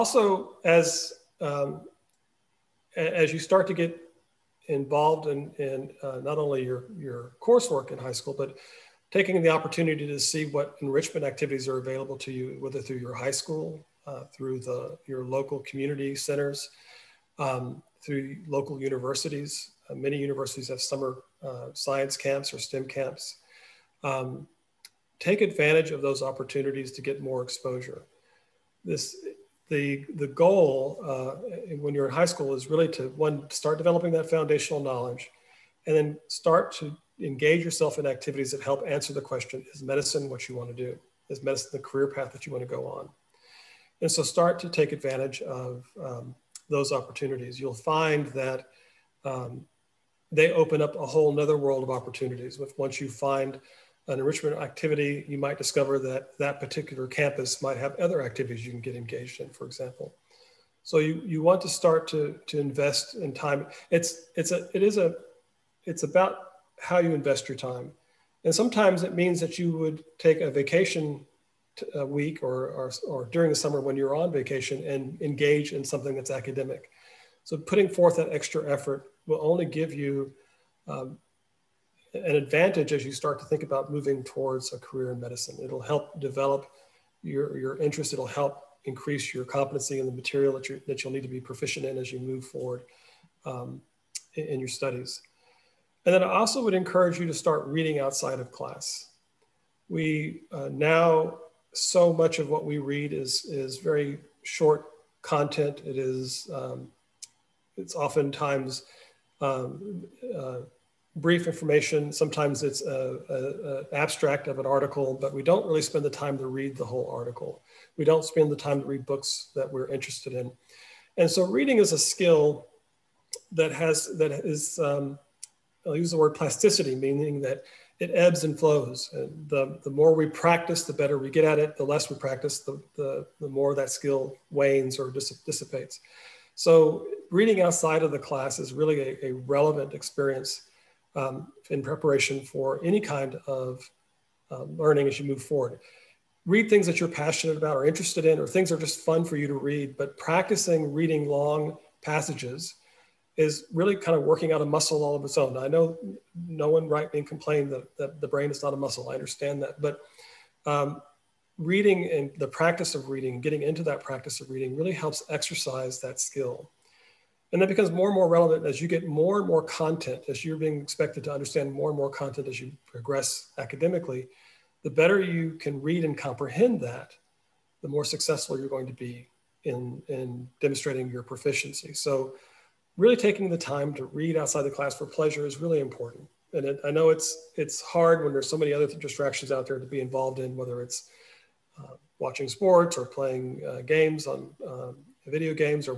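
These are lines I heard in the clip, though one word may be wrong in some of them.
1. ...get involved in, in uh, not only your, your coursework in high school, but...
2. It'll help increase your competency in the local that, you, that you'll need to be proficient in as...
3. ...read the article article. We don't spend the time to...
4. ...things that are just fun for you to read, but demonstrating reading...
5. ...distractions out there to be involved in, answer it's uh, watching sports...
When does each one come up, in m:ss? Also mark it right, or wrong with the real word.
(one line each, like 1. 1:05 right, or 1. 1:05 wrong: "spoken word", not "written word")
1. 0:03 right
2. 1:28 wrong: "material", not "local"
3. 1:56 wrong: "whole", not "article"
4. 2:28 wrong: "practicing", not "demonstrating"
5. 3:08 wrong: "whether", not "answer".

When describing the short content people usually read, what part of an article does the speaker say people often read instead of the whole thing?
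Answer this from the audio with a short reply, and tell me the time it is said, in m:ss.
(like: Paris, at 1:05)
an abstract, at 1:52.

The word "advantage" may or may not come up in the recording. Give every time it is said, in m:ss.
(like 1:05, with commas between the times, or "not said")
0:25, 0:44, 1:22.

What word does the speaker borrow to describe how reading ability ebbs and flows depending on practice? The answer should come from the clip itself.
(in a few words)
plasticity.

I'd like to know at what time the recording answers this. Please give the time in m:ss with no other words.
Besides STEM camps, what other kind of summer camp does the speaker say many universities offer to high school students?
0:21.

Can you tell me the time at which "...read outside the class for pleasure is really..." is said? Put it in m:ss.
3:04.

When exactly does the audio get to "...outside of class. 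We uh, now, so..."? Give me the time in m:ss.
1:37.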